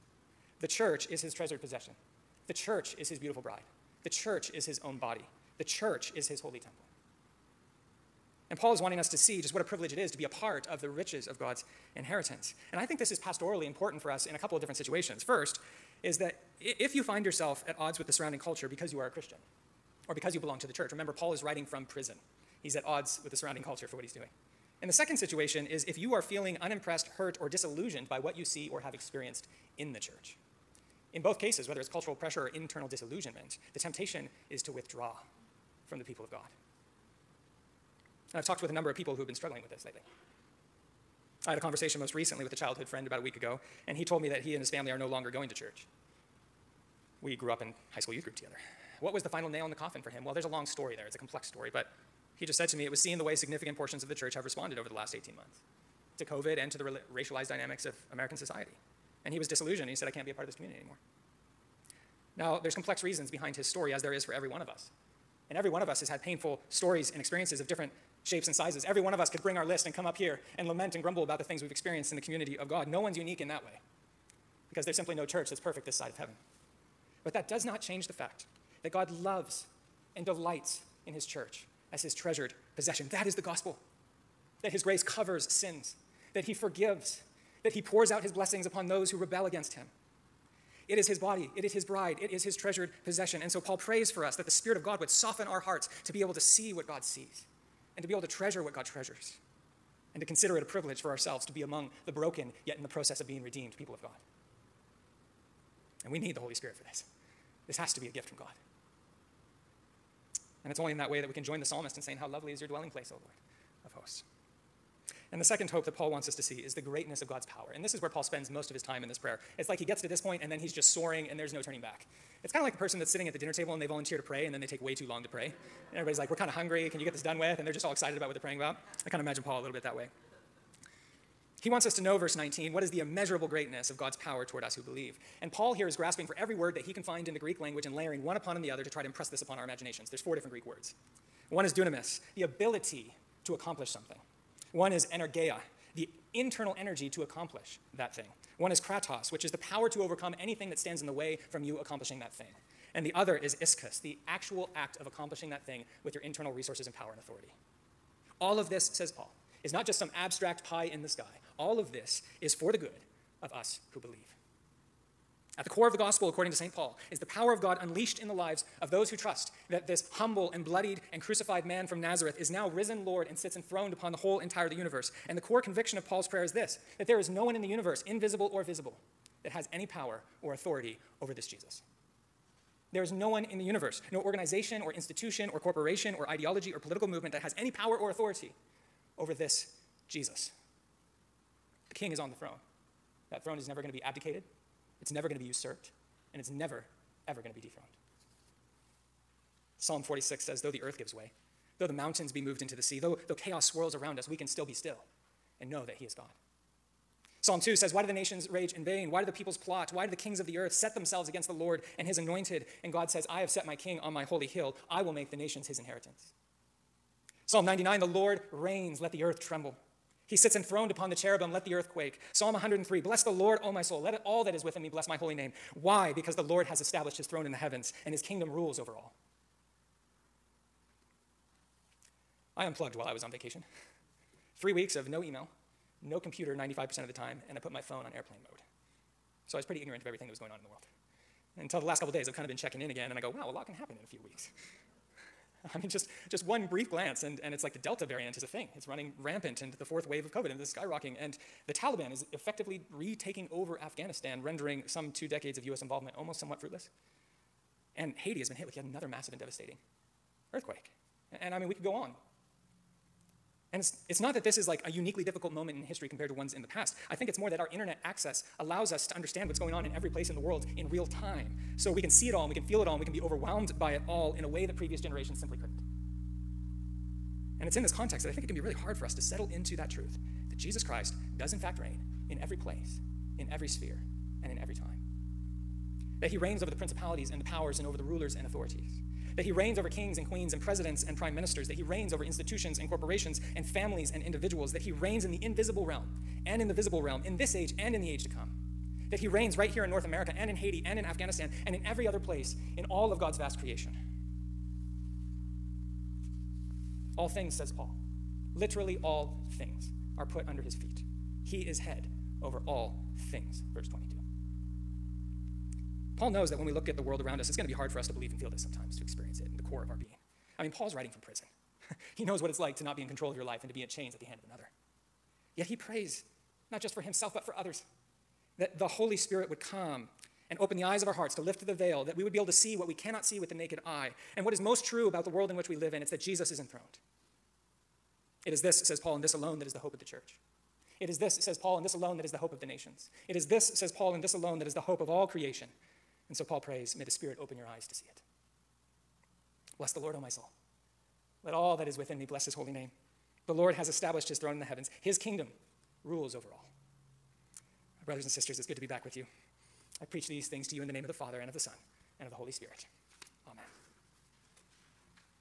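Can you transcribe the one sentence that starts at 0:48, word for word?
What was the final nail in the coffin for him?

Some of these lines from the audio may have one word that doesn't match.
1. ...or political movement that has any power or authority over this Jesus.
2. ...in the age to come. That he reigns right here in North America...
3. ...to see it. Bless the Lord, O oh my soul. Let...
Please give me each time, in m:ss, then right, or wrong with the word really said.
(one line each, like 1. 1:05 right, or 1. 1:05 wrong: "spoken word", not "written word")
1. 3:06 right
2. 4:57 right
3. 5:47 right.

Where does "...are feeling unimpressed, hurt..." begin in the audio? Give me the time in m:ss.
0:26.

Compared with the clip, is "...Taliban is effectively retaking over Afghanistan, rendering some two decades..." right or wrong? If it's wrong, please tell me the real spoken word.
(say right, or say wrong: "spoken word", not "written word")
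right.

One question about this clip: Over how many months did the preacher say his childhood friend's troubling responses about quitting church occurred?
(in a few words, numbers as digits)
18 months.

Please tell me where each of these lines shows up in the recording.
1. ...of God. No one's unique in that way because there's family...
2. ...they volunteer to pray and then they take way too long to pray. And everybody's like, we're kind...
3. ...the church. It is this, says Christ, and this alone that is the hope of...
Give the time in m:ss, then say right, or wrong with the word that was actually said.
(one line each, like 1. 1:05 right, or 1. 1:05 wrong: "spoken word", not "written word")
1. 1:12 wrong: "simply", not "family"
2. 2:03 right
3. 5:39 wrong: "Paul", not "Christ".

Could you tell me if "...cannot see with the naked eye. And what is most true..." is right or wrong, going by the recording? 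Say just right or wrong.
right.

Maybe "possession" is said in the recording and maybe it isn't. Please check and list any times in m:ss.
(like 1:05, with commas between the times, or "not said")
0:01, 1:22, 1:33.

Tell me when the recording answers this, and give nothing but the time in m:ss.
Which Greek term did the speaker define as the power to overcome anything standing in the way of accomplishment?
2:28.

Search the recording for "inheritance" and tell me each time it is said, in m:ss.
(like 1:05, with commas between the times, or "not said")
0:11, 3:35.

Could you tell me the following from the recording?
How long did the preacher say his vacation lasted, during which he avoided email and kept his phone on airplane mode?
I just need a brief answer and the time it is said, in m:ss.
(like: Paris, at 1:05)
3 weeks, at 3:54.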